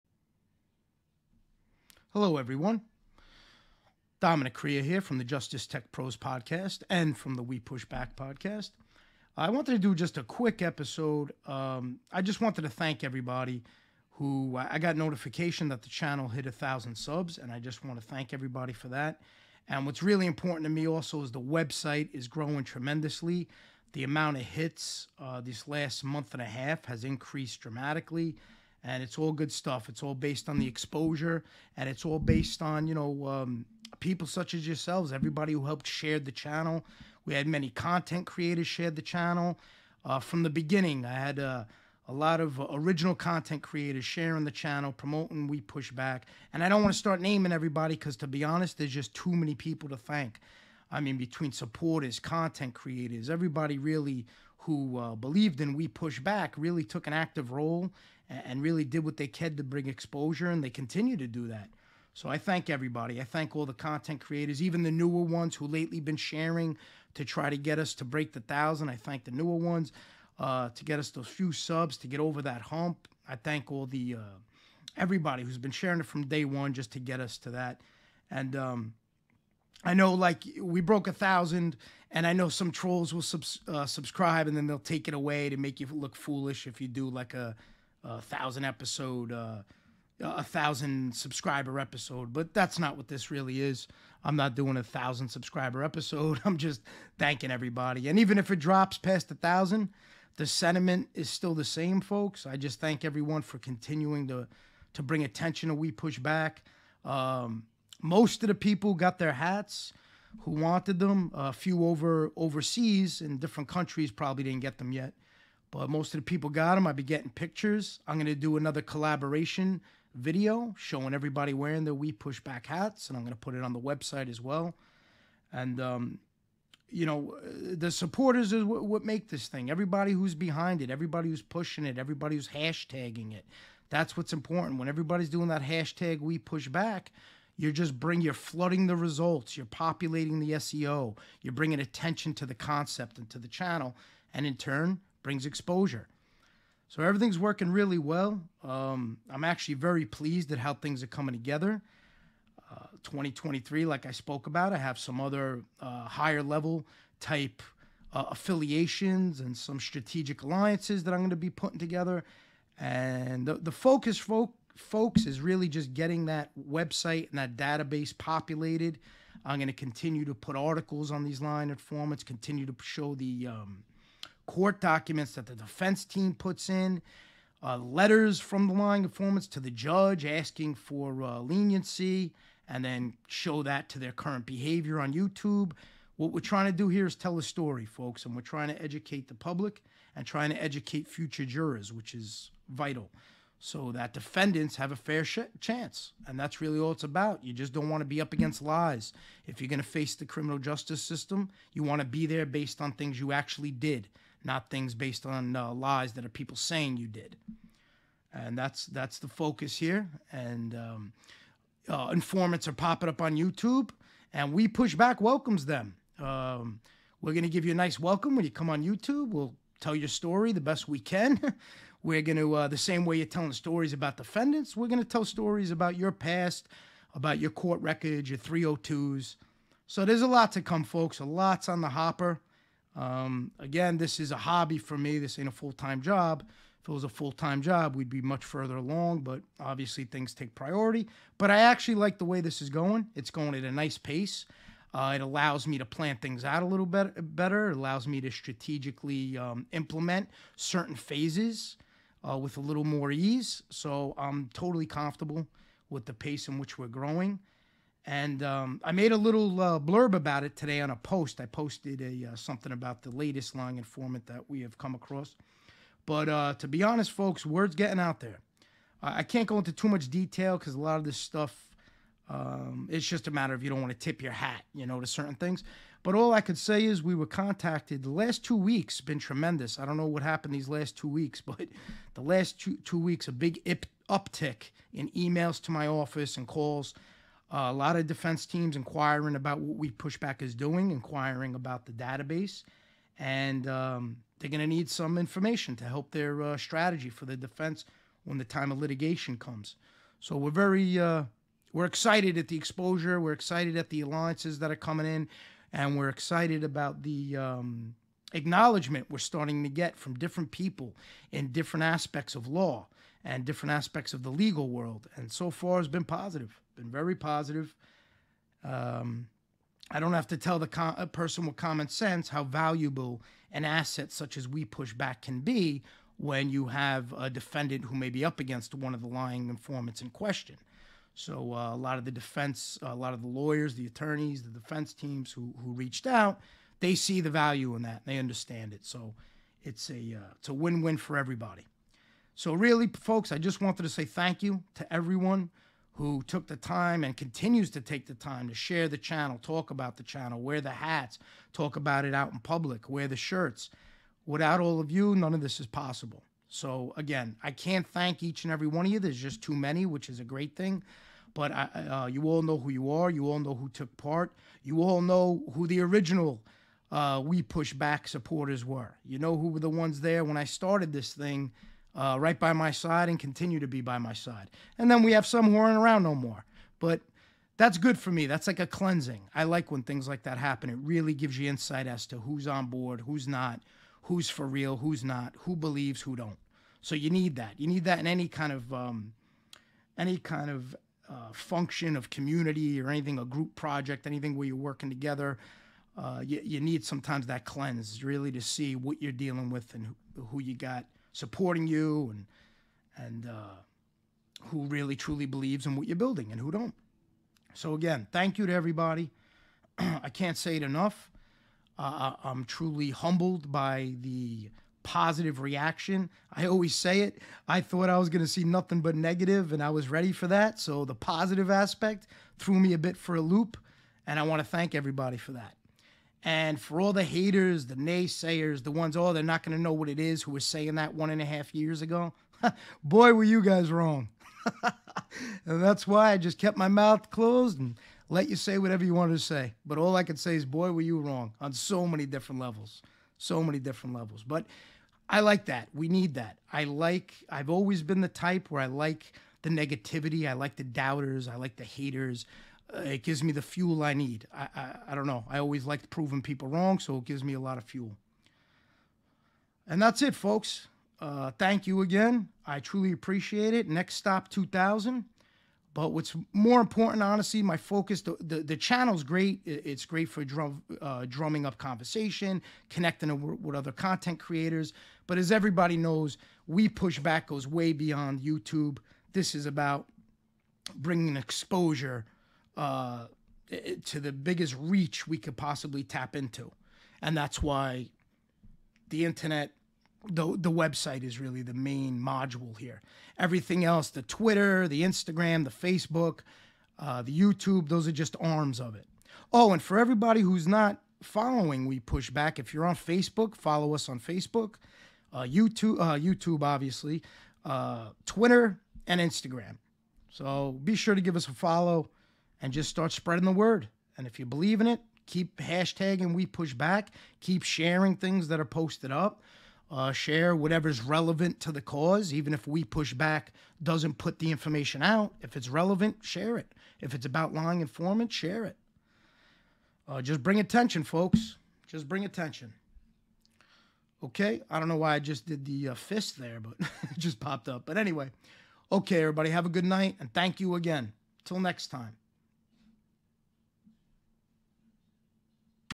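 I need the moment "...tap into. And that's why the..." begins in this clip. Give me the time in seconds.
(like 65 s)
485 s.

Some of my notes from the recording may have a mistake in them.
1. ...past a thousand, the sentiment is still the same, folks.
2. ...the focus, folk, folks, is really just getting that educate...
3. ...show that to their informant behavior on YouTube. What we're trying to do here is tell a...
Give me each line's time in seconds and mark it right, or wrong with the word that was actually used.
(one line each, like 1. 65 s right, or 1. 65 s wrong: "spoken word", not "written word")
1. 98 s right
2. 163 s wrong: "website", not "educate"
3. 183 s wrong: "current", not "informant".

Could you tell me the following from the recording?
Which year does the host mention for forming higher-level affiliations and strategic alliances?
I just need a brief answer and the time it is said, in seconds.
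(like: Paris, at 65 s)
2023, at 153 s.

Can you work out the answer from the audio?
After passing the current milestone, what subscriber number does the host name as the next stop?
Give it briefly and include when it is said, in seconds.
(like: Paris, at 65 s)
2000, at 464 s.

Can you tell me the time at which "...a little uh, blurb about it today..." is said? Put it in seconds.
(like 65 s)
259 s.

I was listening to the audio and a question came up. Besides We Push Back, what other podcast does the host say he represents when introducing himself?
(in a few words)
Justice Tech Pros.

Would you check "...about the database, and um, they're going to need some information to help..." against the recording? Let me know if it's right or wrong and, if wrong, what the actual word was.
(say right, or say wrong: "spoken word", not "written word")
right.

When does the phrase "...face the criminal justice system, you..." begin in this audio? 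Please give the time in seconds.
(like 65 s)
199 s.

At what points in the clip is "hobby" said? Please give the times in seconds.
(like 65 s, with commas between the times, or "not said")
234 s.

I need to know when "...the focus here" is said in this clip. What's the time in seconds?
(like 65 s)
209 s.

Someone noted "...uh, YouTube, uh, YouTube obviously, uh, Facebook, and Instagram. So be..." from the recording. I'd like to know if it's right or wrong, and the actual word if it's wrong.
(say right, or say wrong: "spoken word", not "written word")
wrong: "Twitter", not "Facebook".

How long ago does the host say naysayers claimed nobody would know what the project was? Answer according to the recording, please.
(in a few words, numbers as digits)
one and a half years.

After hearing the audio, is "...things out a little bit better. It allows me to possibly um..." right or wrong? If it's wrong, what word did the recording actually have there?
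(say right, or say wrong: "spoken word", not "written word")
wrong: "strategically", not "possibly".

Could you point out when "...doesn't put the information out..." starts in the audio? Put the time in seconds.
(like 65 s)
523 s.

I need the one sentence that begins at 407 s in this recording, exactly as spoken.
So again, thank you to everybody.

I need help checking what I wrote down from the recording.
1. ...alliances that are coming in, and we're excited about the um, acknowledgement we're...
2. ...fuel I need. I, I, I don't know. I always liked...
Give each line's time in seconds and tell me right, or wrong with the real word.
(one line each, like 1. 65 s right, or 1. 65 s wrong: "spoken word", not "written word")
1. 304 s right
2. 453 s right.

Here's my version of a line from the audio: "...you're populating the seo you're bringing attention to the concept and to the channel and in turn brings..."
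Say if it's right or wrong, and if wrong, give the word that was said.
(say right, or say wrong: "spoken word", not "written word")
right.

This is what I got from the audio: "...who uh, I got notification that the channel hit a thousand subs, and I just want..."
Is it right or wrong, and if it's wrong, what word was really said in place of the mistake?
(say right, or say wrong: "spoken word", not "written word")
right.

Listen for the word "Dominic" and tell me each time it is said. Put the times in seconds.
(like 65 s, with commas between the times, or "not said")
4 s.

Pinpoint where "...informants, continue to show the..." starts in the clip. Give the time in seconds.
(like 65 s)
171 s.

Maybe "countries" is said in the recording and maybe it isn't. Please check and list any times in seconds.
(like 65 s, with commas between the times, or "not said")
113 s.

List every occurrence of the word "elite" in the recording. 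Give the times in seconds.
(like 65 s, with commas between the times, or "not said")
not said.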